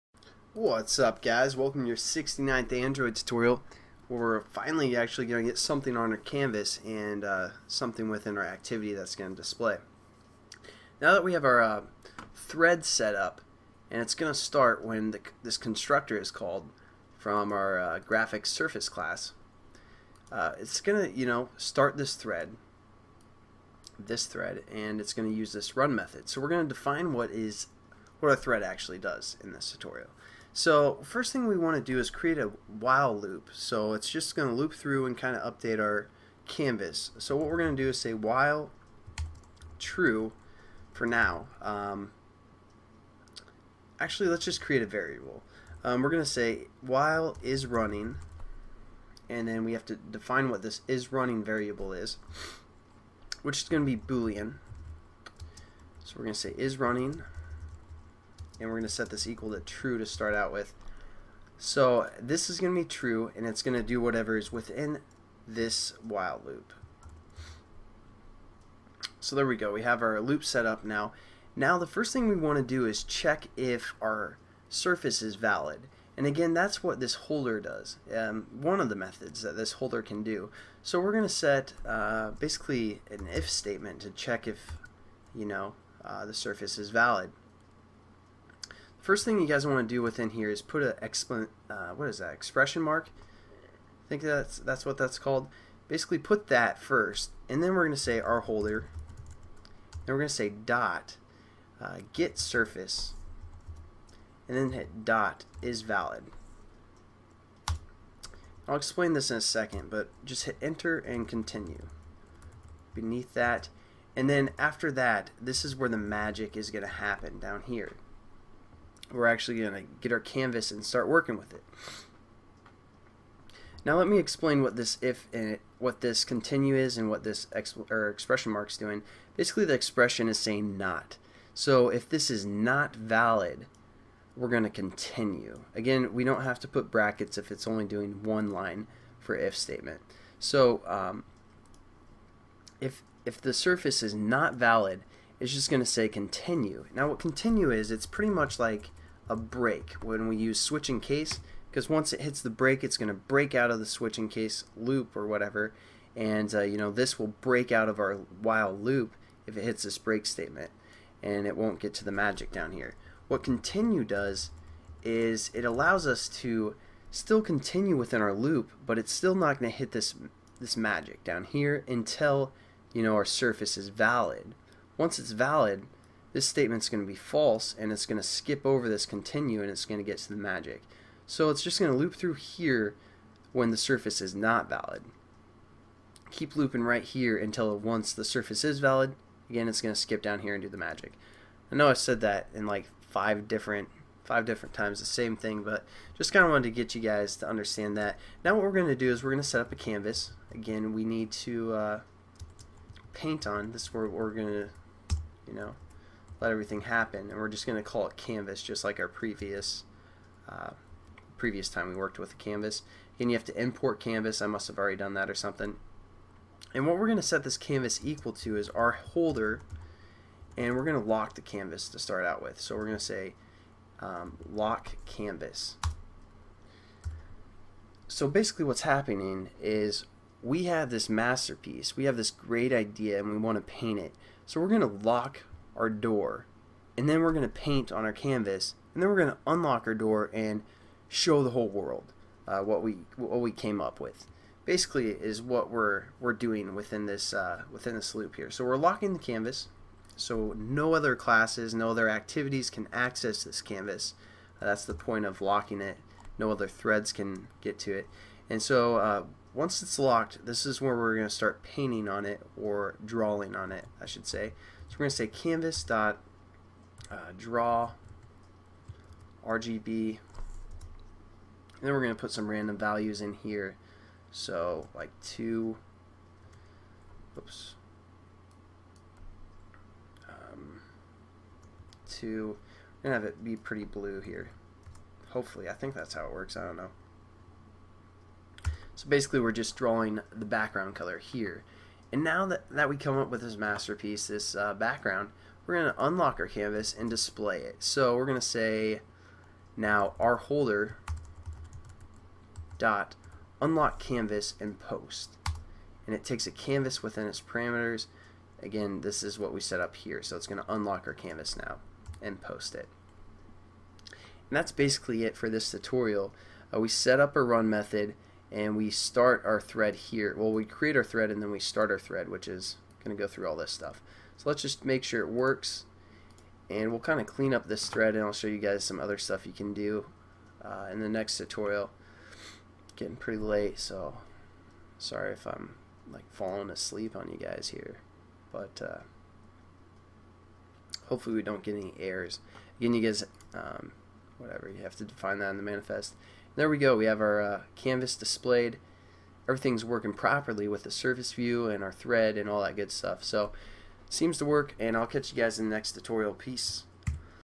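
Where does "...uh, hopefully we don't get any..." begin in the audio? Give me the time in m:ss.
5:38.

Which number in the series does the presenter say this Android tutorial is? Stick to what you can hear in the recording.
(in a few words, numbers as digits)
69th.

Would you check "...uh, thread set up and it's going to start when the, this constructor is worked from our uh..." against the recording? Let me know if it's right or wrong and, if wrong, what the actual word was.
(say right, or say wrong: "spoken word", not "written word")
wrong: "called", not "worked".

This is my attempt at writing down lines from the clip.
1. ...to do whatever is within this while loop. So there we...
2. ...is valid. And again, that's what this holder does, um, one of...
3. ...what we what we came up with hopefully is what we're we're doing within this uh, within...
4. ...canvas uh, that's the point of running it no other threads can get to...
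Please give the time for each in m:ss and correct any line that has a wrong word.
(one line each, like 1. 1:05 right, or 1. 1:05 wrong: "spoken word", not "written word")
1. 1:03 right
2. 1:15 right
3. 4:02 wrong: "basically", not "hopefully"
4. 4:13 wrong: "locking", not "running".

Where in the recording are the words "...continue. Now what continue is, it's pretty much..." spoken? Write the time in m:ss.
2:26.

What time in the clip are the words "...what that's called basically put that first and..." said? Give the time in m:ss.
1:34.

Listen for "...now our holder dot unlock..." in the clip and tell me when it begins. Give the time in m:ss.
4:59.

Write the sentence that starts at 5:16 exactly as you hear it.
Uh, we set up a run method and we start our thread here.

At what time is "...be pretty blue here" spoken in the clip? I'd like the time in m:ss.
4:43.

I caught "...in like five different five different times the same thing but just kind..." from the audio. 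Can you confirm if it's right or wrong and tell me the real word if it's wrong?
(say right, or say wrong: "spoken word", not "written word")
right.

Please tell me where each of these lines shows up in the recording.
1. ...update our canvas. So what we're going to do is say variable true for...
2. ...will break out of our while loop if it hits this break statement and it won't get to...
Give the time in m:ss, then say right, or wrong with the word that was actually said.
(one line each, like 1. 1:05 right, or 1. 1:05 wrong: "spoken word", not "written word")
1. 0:35 wrong: "while", not "variable"
2. 2:37 right.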